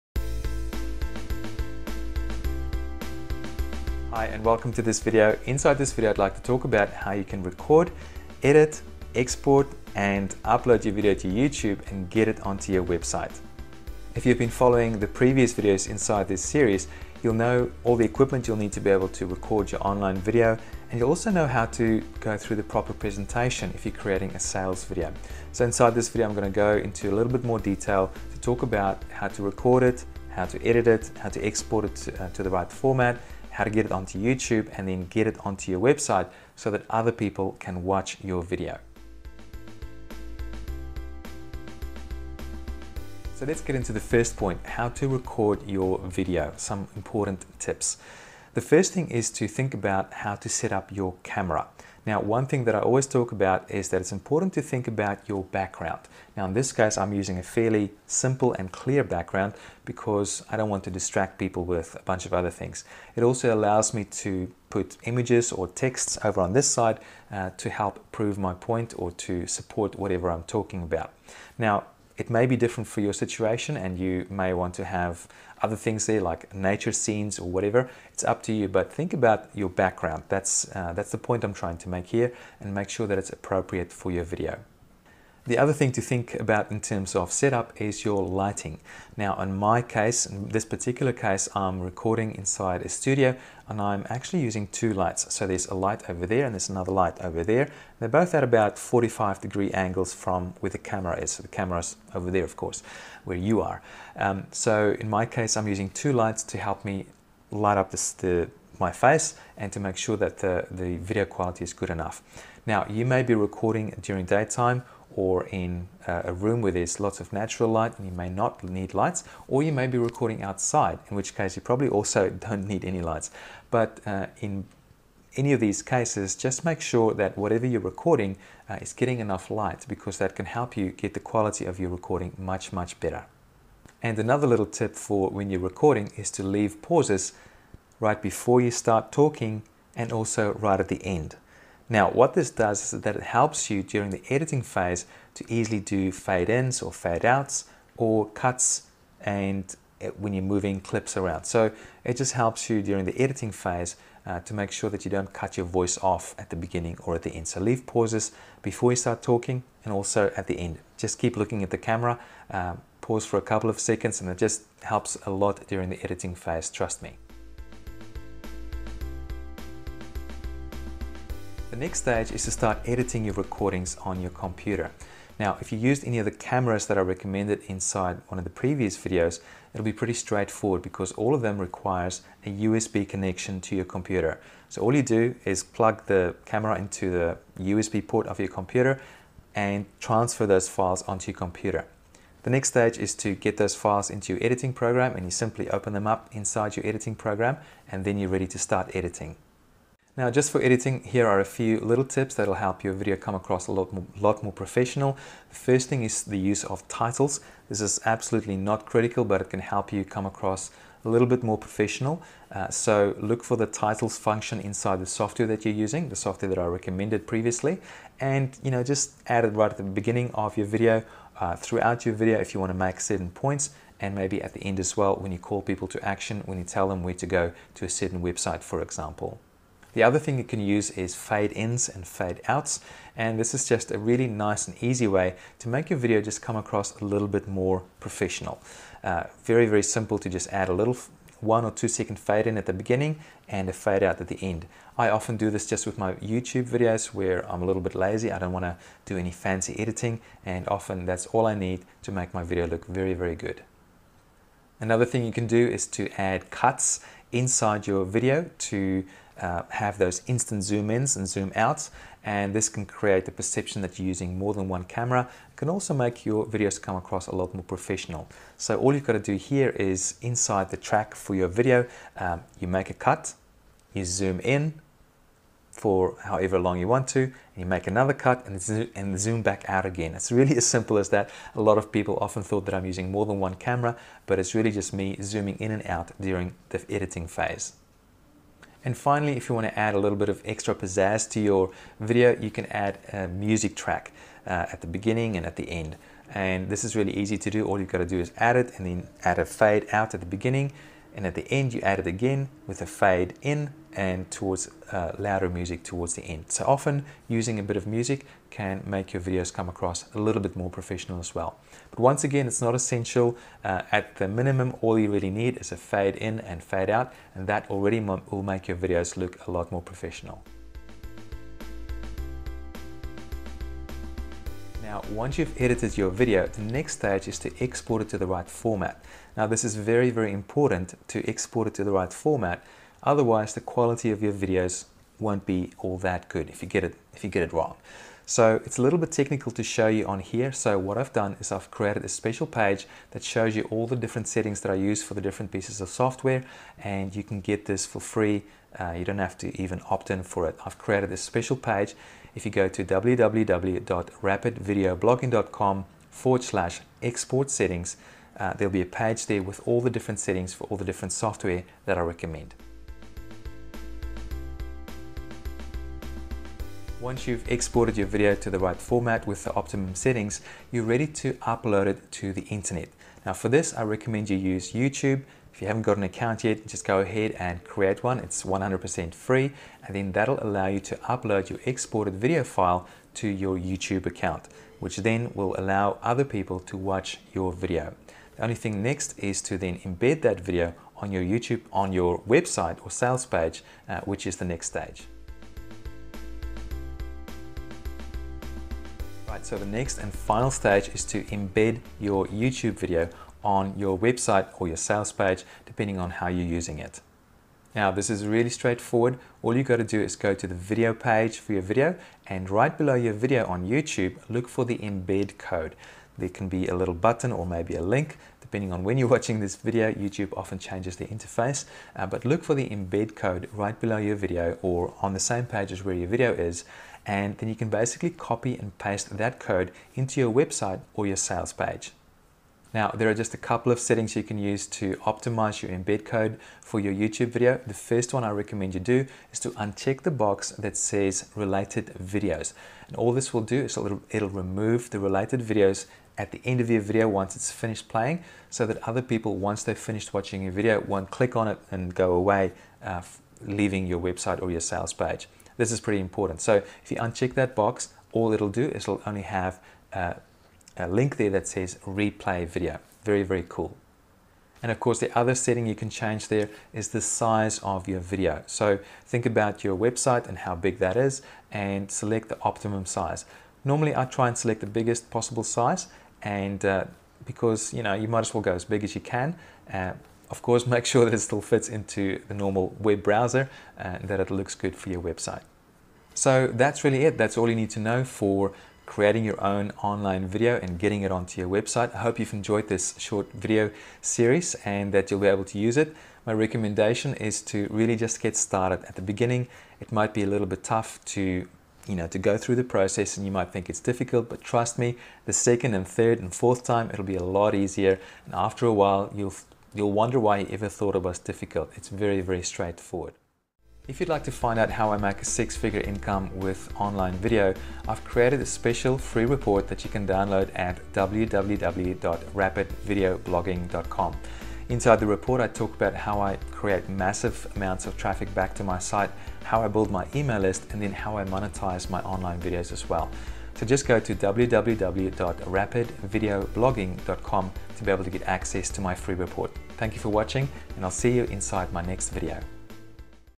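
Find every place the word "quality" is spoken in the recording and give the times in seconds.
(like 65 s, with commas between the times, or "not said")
111 s, 131 s, 333 s.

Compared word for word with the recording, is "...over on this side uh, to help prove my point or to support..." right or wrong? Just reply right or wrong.
right.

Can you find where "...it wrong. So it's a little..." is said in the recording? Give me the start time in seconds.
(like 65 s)
337 s.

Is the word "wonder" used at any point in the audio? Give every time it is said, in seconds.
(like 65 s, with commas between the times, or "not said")
509 s.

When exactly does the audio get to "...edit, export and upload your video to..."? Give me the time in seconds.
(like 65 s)
8 s.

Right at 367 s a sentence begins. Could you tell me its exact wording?
Once you've exported your video to the right format with the optimum settings, you're ready to upload it to the internet.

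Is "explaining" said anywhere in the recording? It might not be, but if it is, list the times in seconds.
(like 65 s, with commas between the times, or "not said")
not said.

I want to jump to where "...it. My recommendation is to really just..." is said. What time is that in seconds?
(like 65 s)
495 s.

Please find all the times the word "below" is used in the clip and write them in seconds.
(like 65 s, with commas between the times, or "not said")
412 s, 423 s.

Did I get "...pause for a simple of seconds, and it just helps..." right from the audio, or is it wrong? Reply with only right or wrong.
wrong.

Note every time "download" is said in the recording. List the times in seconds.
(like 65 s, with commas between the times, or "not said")
520 s.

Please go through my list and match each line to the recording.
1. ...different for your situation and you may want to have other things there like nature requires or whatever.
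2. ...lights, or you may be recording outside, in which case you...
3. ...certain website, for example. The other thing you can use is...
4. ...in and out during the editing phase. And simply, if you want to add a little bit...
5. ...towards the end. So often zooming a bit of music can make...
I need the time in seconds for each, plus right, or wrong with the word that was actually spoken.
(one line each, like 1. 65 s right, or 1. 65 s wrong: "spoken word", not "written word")
1. 72 s wrong: "scenes", not "requires"
2. 118 s right
3. 227 s right
4. 285 s wrong: "finally", not "simply"
5. 305 s wrong: "using", not "zooming".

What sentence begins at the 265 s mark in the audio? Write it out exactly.
It can also make your videos come across a lot more professional.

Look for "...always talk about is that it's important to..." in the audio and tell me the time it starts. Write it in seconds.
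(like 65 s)
52 s.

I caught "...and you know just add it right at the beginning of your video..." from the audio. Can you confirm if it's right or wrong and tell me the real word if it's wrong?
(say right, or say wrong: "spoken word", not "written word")
right.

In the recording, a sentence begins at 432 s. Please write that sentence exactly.
Now, there are just a couple of settings you can use to optimize your embed code for your YouTube video.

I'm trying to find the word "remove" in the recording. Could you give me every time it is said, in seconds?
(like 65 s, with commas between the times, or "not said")
444 s.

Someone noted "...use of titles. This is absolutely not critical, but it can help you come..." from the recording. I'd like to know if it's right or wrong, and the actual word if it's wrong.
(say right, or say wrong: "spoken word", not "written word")
right.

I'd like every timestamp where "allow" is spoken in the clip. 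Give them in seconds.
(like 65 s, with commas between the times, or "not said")
63 s, 380 s, 385 s.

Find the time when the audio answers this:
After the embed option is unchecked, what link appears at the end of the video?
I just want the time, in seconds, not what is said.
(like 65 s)
461 s.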